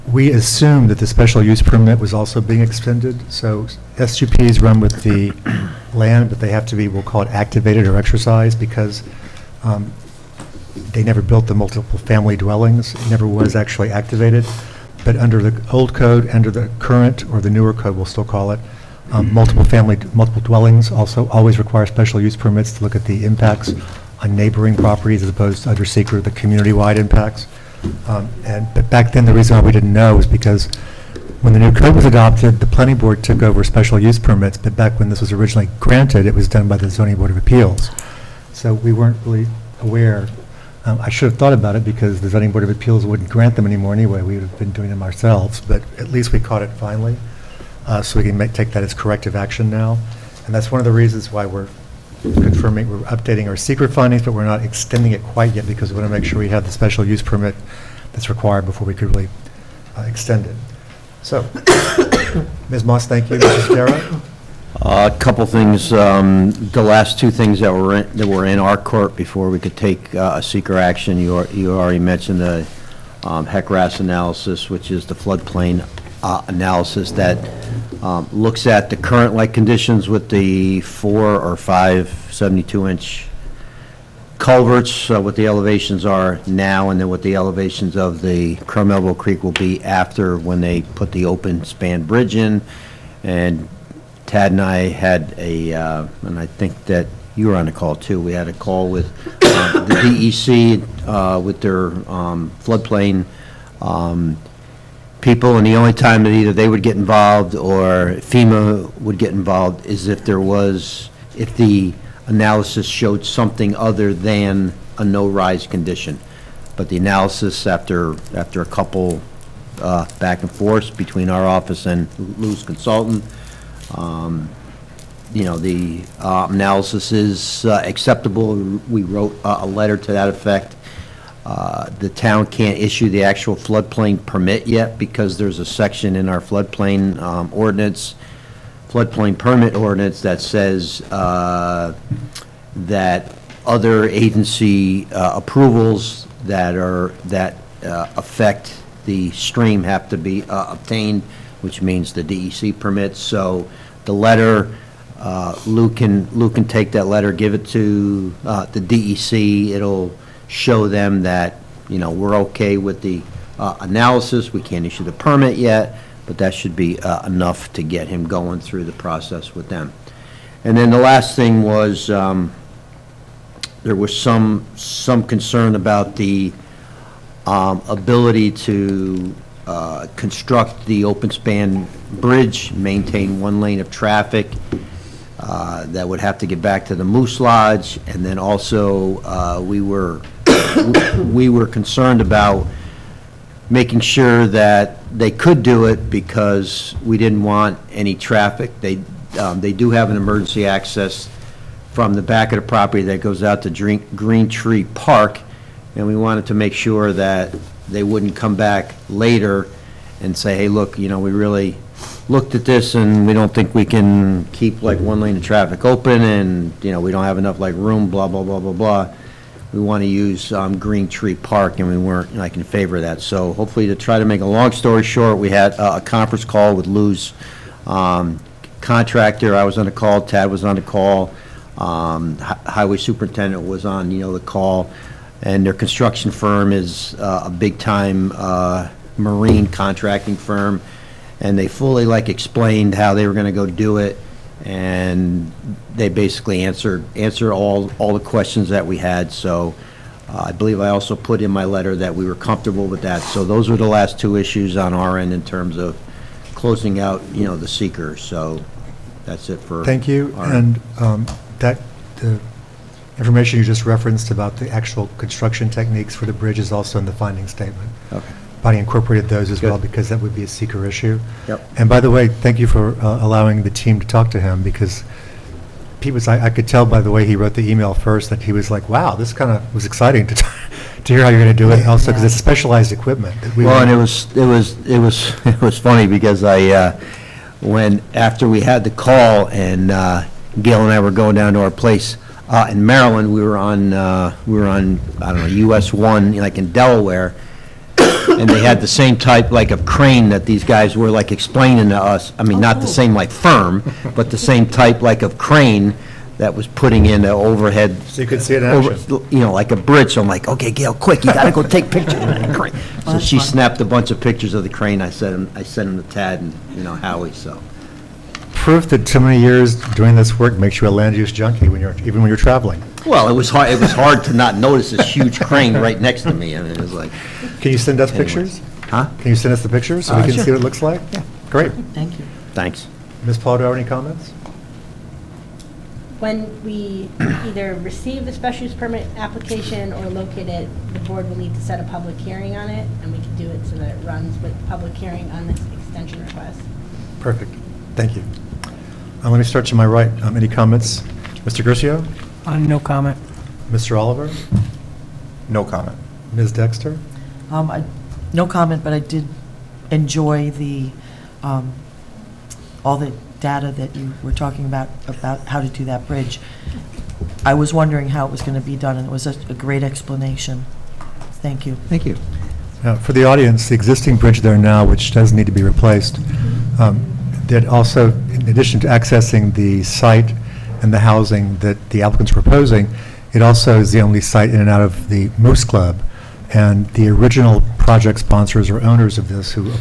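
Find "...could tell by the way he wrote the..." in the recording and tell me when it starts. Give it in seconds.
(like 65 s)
276 s.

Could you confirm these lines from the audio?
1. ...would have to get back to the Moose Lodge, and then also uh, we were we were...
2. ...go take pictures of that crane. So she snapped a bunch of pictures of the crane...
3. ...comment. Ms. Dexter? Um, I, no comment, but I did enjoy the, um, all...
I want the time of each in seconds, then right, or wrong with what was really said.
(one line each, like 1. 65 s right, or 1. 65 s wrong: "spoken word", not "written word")
1. 186 s right
2. 311 s right
3. 355 s right.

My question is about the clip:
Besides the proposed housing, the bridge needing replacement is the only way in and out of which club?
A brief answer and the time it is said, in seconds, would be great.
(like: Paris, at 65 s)
Moose Club, at 385 s.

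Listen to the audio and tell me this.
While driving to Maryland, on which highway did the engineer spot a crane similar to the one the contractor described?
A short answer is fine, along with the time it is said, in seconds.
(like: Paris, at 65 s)
US 1, at 295 s.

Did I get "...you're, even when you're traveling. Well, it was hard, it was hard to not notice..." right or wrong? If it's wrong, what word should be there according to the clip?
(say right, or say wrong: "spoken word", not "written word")
right.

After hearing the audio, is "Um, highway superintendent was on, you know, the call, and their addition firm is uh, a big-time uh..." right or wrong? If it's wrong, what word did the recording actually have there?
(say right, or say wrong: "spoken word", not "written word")
wrong: "construction", not "addition".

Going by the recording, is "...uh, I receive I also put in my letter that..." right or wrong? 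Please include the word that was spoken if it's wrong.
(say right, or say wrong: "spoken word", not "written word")
wrong: "believe", not "receive".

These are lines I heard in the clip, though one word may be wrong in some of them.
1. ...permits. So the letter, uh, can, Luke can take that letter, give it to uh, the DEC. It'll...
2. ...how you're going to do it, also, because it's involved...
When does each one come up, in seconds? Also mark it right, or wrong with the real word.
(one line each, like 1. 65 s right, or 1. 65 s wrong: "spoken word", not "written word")
1. 152 s right
2. 281 s wrong: "specialized", not "involved".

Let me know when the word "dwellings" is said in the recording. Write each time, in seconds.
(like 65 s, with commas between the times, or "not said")
12 s, 20 s.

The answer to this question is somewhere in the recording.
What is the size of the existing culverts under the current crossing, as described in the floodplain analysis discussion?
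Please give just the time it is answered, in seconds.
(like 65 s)
82 s.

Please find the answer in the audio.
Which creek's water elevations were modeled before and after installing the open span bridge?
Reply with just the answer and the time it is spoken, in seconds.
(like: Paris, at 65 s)
Crum Creek, at 88 s.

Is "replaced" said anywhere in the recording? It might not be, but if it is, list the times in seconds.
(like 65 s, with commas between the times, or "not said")
375 s.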